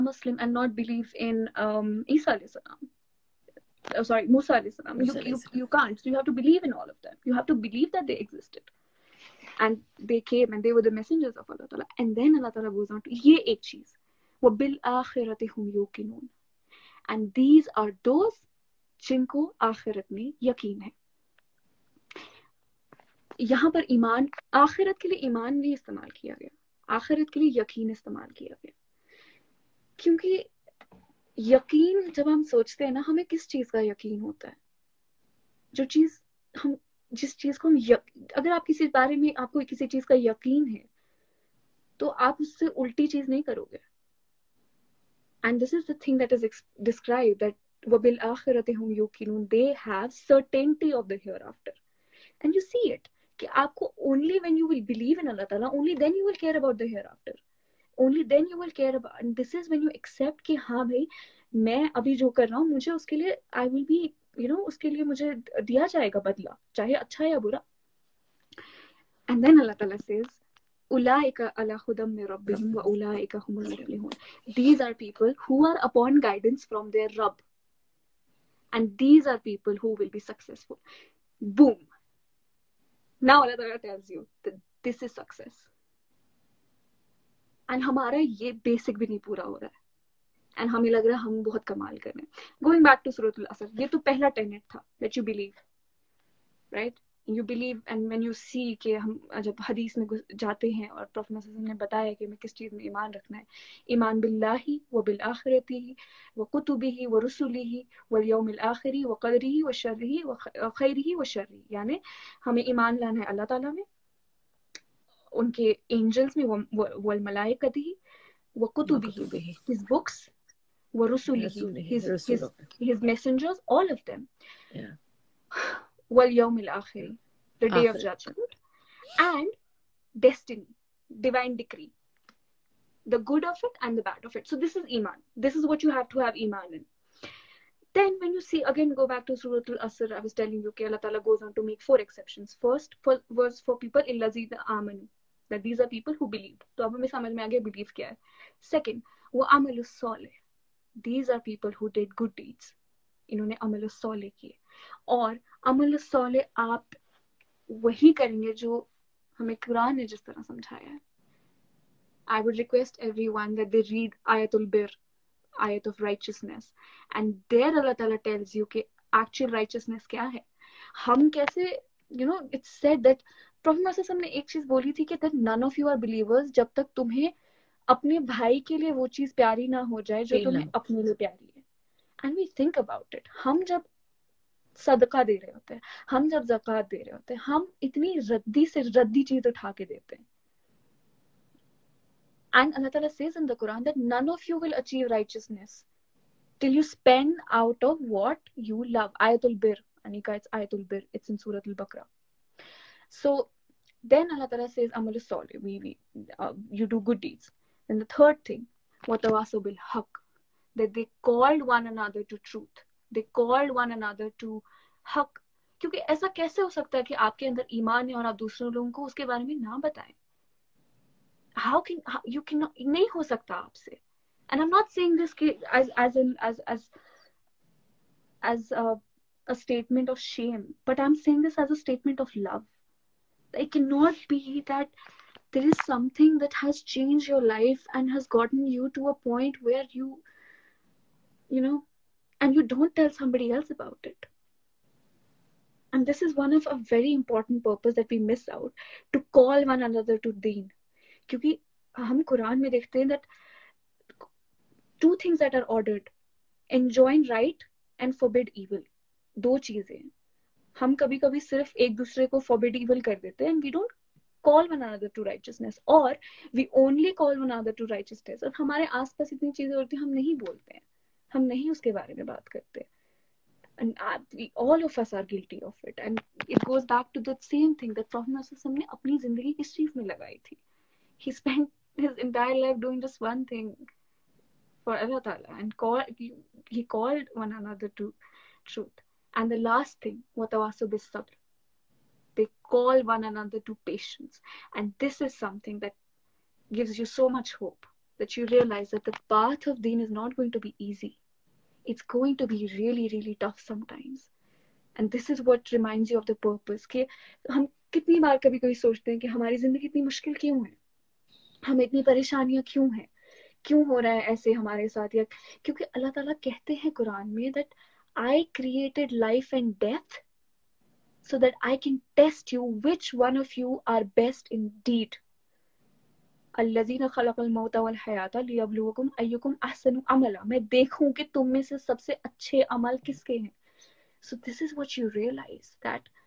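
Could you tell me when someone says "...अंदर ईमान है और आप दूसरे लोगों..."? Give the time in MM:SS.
03:37.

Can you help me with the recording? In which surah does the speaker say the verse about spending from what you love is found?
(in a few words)
Surah Al Baqarah.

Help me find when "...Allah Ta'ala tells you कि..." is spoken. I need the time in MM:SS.
02:47.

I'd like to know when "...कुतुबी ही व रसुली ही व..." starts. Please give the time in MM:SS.
01:46.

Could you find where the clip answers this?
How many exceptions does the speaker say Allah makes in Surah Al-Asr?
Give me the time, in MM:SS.
02:21.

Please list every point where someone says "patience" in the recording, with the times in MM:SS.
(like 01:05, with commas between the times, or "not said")
04:53.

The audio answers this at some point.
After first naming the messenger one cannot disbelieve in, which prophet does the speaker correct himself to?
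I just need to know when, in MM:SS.
00:04.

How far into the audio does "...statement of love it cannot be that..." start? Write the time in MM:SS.
03:51.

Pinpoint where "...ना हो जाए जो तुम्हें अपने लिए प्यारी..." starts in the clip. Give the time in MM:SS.
02:59.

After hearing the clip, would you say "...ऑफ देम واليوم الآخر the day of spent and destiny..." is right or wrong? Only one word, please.
wrong.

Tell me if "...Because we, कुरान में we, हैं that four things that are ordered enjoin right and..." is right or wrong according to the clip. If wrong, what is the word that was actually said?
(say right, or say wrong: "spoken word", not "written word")
wrong: "two", not "four".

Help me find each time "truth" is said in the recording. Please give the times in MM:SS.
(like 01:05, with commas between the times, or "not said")
03:32, 04:48.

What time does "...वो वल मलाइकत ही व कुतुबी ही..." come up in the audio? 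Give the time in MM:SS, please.
01:56.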